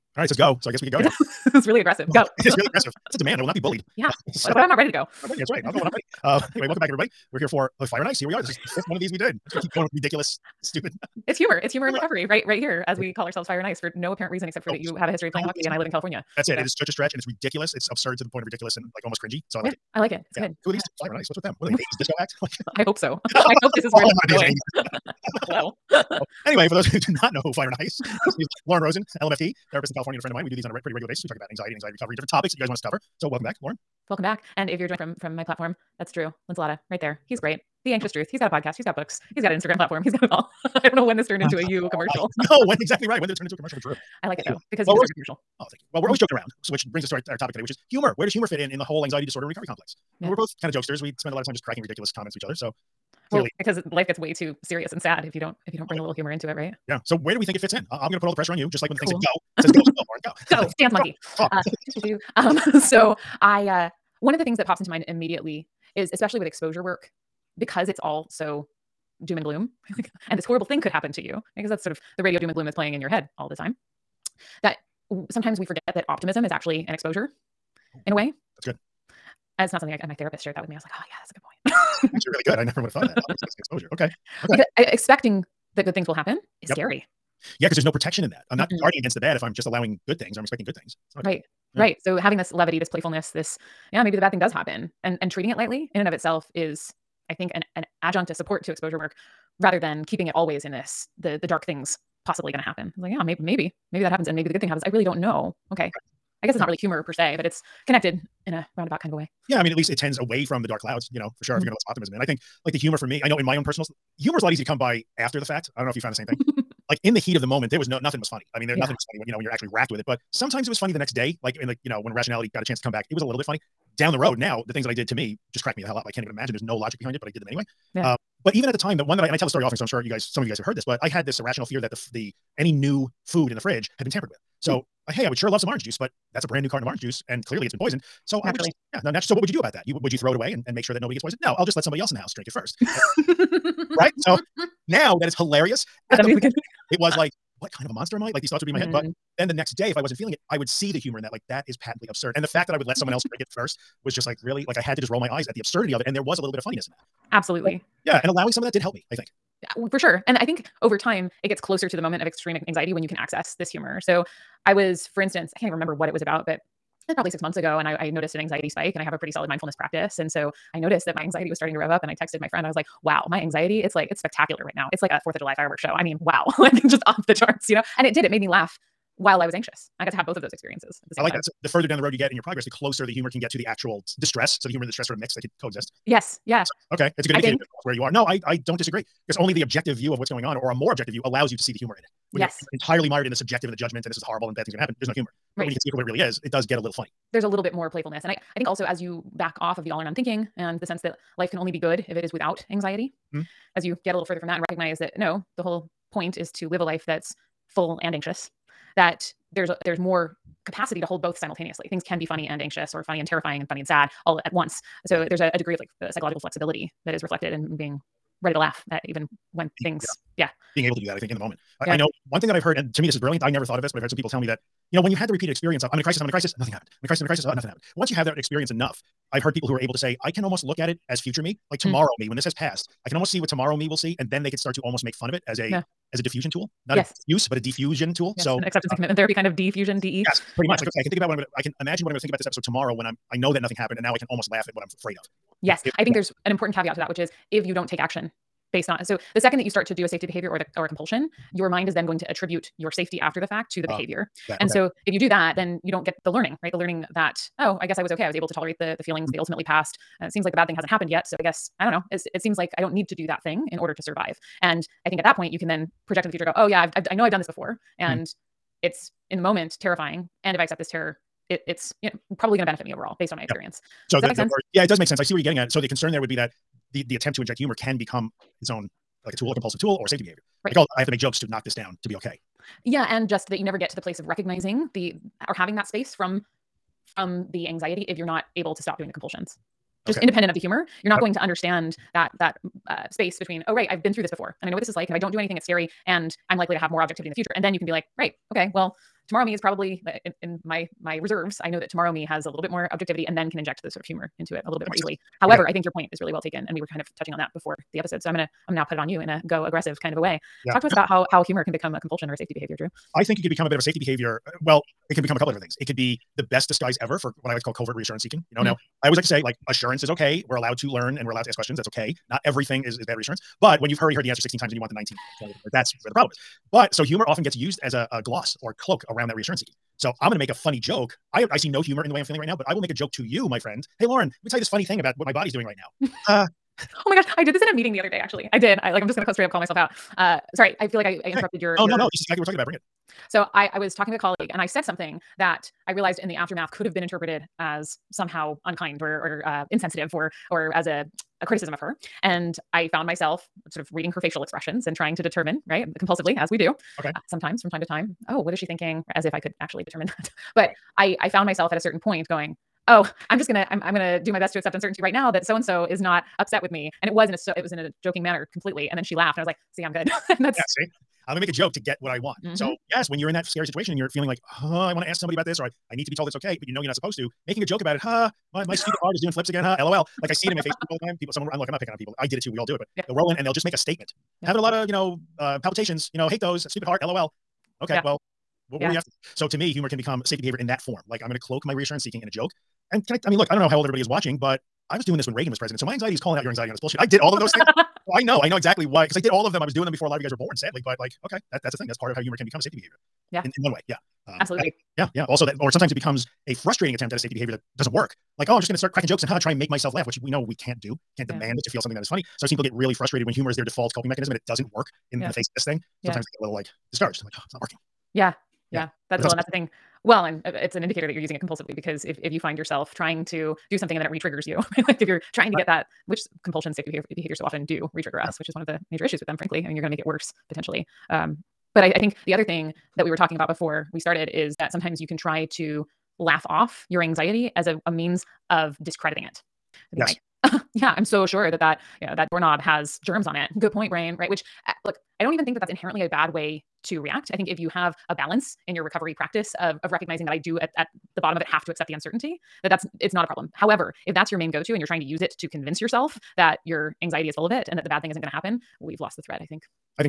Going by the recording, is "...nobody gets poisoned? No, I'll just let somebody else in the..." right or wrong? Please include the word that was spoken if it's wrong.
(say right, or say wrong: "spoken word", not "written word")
right.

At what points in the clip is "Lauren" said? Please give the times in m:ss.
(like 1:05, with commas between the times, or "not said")
0:28, 0:33, 1:00, 5:34.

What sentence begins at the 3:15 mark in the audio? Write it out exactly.
but when you can see it for what it really is, it does get a little funny.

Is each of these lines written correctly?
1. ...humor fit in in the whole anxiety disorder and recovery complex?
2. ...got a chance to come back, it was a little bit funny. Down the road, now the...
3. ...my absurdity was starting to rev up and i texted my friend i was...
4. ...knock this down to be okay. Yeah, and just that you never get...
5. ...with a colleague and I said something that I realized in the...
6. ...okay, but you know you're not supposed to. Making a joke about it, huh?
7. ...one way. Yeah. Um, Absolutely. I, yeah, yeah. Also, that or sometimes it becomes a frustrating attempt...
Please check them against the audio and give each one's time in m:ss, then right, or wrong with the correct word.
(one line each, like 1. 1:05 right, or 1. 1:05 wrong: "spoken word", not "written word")
1. 0:48 right
2. 2:02 right
3. 2:51 wrong: "anxiety", not "absurdity"
4. 4:41 right
5. 5:44 right
6. 6:16 right
7. 6:43 right.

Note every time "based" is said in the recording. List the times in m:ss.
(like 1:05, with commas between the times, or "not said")
4:08, 4:33.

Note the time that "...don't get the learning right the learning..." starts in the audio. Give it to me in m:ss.
4:15.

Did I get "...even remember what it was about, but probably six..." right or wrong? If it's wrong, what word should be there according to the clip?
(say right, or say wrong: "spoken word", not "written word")
right.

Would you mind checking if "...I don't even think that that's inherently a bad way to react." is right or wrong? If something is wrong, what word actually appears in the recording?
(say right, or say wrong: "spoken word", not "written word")
right.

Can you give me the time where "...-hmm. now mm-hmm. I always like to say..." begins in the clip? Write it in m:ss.
5:18.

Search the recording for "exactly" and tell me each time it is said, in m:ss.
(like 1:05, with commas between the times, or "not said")
0:42, 5:42, 6:38.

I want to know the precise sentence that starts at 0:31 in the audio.
We talk about anxiety and anxiety recovery and different topics that you guys want us to cover.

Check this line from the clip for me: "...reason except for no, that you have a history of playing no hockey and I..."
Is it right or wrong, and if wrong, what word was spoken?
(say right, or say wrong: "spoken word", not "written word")
right.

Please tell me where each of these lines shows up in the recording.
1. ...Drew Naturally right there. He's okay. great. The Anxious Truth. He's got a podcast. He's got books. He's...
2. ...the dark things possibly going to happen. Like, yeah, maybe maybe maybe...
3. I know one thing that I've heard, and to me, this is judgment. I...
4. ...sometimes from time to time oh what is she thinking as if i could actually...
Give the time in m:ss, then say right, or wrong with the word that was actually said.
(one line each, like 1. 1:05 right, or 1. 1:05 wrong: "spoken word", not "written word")
1. 0:36 wrong: "Linsalata", not "Naturally"
2. 1:41 right
3. 3:41 wrong: "brilliant", not "judgment"
4. 5:57 right.